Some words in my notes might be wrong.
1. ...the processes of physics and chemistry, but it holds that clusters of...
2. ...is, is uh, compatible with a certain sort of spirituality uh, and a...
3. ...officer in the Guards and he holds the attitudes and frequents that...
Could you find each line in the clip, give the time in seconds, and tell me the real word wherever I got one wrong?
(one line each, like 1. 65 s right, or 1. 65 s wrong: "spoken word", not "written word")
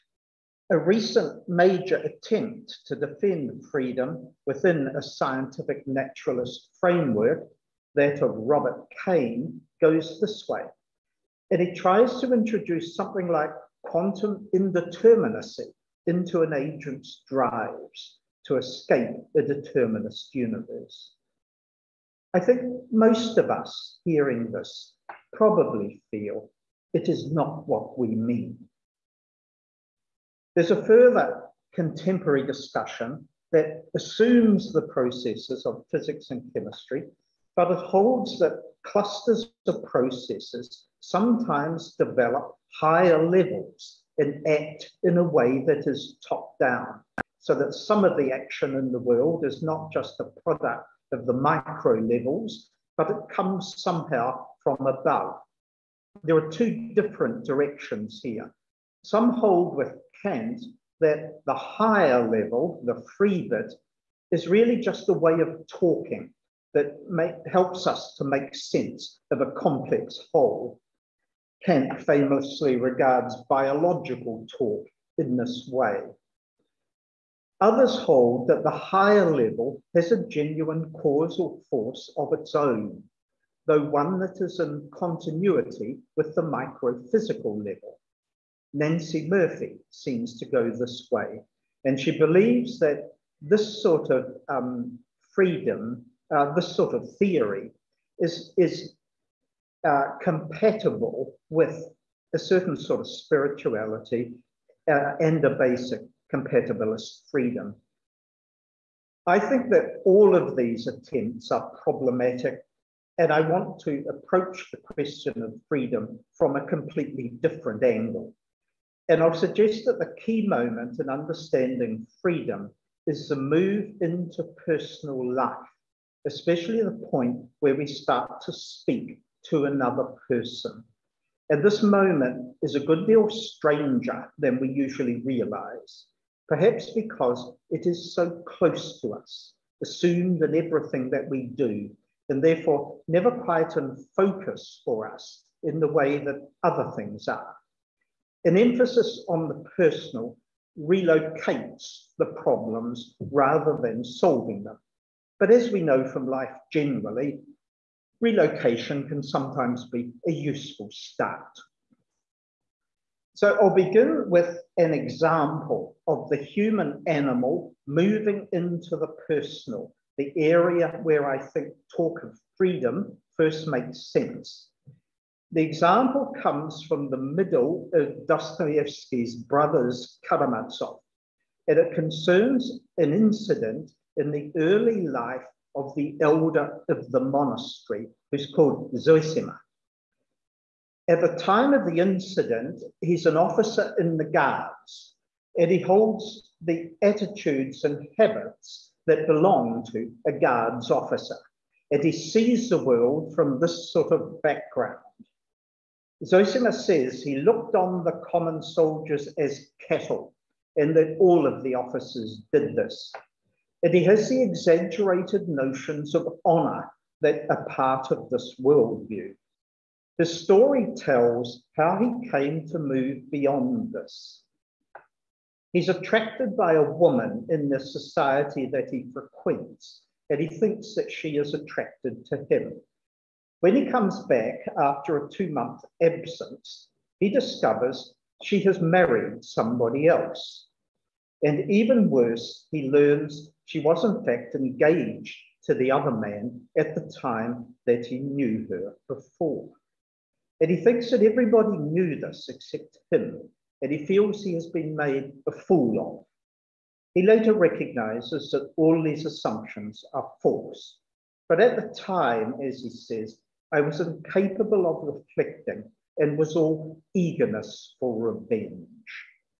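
1. 34 s right
2. 98 s right
3. 193 s wrong: "habits", not "frequents".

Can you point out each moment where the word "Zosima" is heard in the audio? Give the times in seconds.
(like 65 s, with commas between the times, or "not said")
188 s, 206 s.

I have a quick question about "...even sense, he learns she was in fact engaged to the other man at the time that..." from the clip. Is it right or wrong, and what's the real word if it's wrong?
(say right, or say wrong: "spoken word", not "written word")
wrong: "worse", not "sense".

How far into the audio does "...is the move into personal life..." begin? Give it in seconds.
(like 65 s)
123 s.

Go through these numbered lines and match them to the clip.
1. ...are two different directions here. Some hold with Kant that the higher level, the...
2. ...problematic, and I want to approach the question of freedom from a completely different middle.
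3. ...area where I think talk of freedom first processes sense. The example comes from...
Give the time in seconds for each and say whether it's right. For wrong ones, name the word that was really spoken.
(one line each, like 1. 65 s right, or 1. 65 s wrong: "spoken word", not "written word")
1. 56 s right
2. 111 s wrong: "angle", not "middle"
3. 170 s wrong: "makes", not "processes".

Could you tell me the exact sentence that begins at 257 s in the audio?
He later recognizes that all these assumptions are false.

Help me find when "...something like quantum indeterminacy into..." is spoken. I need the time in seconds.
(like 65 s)
12 s.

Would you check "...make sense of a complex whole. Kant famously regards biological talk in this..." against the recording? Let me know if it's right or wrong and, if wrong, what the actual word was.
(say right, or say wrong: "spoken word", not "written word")
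right.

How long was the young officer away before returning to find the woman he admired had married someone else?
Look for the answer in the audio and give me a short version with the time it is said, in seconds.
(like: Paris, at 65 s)
2 months, at 235 s.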